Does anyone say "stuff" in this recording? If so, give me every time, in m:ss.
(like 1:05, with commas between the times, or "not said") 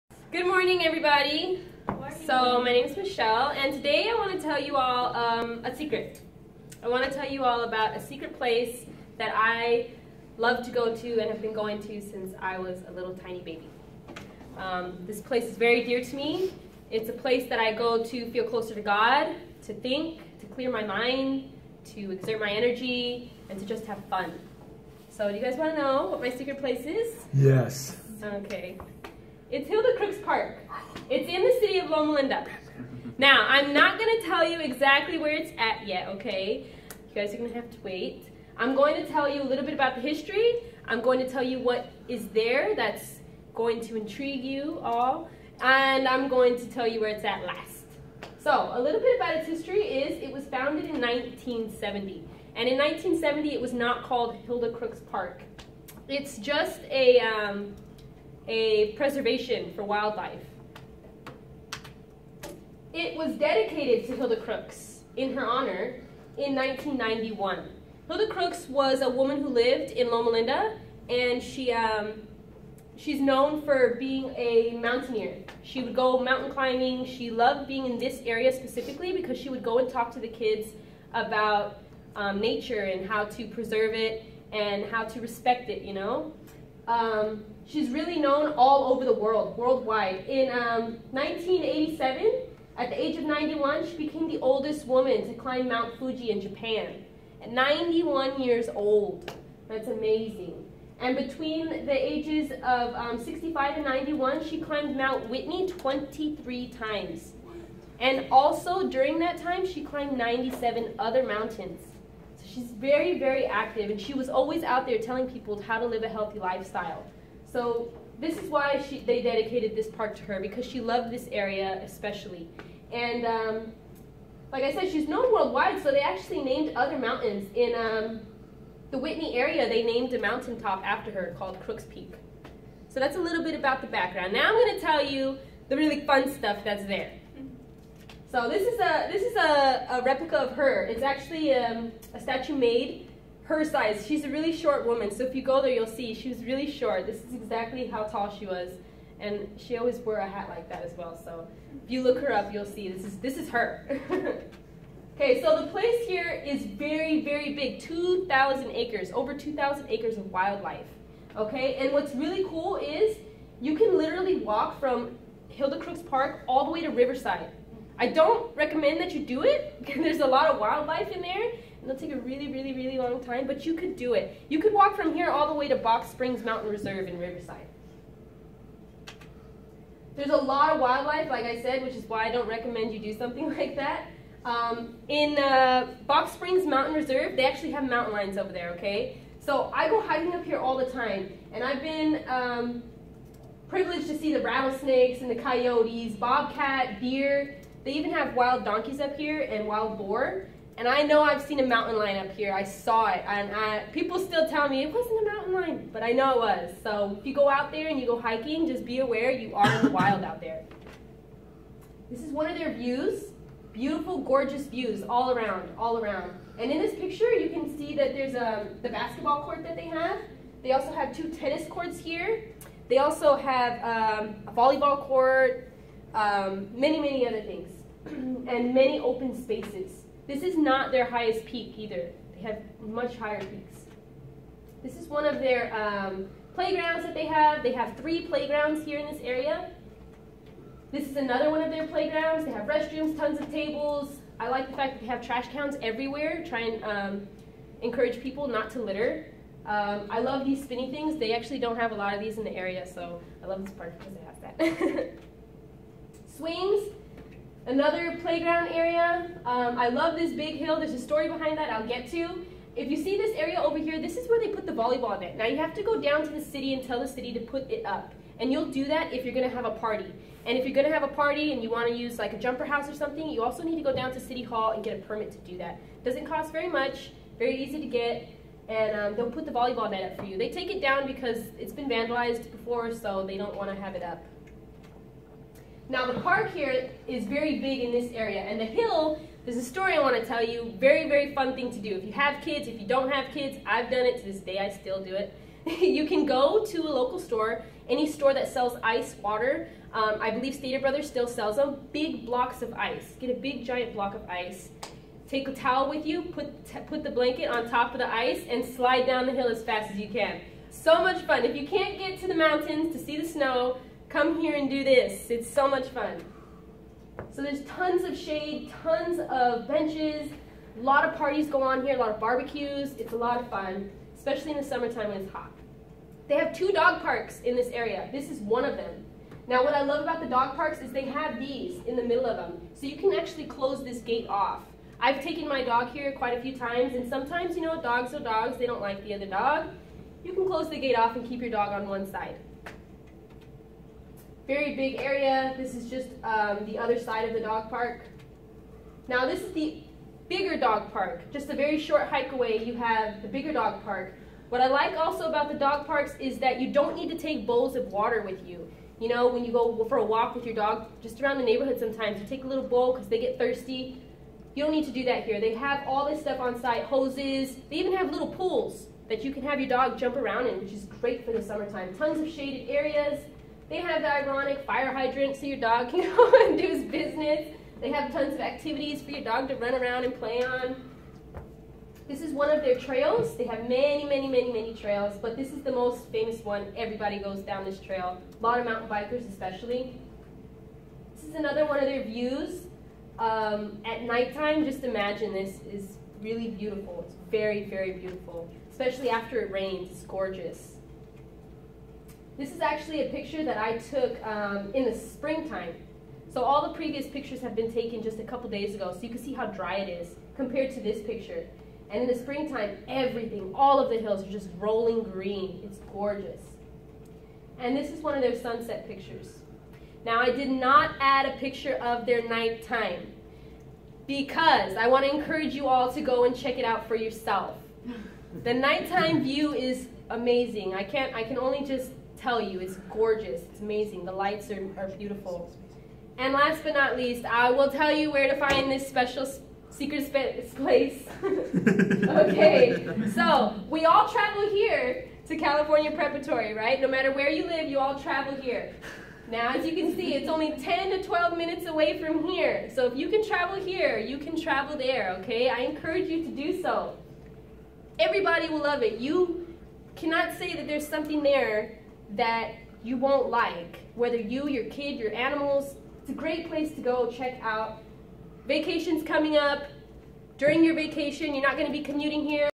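2:16, 6:06.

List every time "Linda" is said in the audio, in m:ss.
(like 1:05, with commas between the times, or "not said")
0:32, 1:10.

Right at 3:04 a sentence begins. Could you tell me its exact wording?
Um, in uh, Box Springs Mountain Reserve, they actually have mountain lions over there, okay?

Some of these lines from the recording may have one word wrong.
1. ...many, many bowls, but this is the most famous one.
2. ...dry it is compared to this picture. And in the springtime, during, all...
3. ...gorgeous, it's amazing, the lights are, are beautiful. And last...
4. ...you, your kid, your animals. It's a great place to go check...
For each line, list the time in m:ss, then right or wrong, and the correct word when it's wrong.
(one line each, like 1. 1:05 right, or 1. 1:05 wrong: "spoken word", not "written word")
1. 6:24 wrong: "trails", not "bowls"
2. 6:49 wrong: "everything", not "during"
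3. 7:12 right
4. 7:44 right.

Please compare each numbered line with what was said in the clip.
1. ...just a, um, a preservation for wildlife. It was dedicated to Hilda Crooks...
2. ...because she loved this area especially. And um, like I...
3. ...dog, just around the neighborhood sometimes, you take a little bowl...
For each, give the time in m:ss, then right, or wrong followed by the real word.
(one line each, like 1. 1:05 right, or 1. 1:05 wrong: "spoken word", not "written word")
1. 0:56 right
2. 2:00 right
3. 6:00 right.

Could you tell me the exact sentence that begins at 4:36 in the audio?
Doesn't cost very much, very easy to get, and um, they'll put the volleyball net up for you.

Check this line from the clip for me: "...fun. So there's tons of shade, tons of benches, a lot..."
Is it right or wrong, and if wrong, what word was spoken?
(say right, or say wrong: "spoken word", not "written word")
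right.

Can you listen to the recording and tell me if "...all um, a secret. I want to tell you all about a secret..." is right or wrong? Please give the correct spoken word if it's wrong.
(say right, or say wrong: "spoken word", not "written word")
right.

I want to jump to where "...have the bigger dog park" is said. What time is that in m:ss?
5:52.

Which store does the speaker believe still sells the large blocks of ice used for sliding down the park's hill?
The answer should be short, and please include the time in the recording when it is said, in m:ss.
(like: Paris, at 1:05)
Stater Brothers, at 5:00.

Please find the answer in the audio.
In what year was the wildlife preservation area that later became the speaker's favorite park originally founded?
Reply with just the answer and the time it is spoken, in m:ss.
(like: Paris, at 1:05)
1970, at 0:50.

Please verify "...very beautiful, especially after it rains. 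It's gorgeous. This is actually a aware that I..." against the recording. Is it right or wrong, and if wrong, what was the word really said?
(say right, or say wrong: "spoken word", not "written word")
wrong: "picture", not "aware".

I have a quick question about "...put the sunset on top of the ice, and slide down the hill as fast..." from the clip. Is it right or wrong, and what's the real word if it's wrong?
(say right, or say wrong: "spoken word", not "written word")
wrong: "blanket", not "sunset".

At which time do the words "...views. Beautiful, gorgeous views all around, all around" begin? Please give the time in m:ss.
3:32.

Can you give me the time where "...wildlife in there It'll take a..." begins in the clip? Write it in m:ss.
2:50.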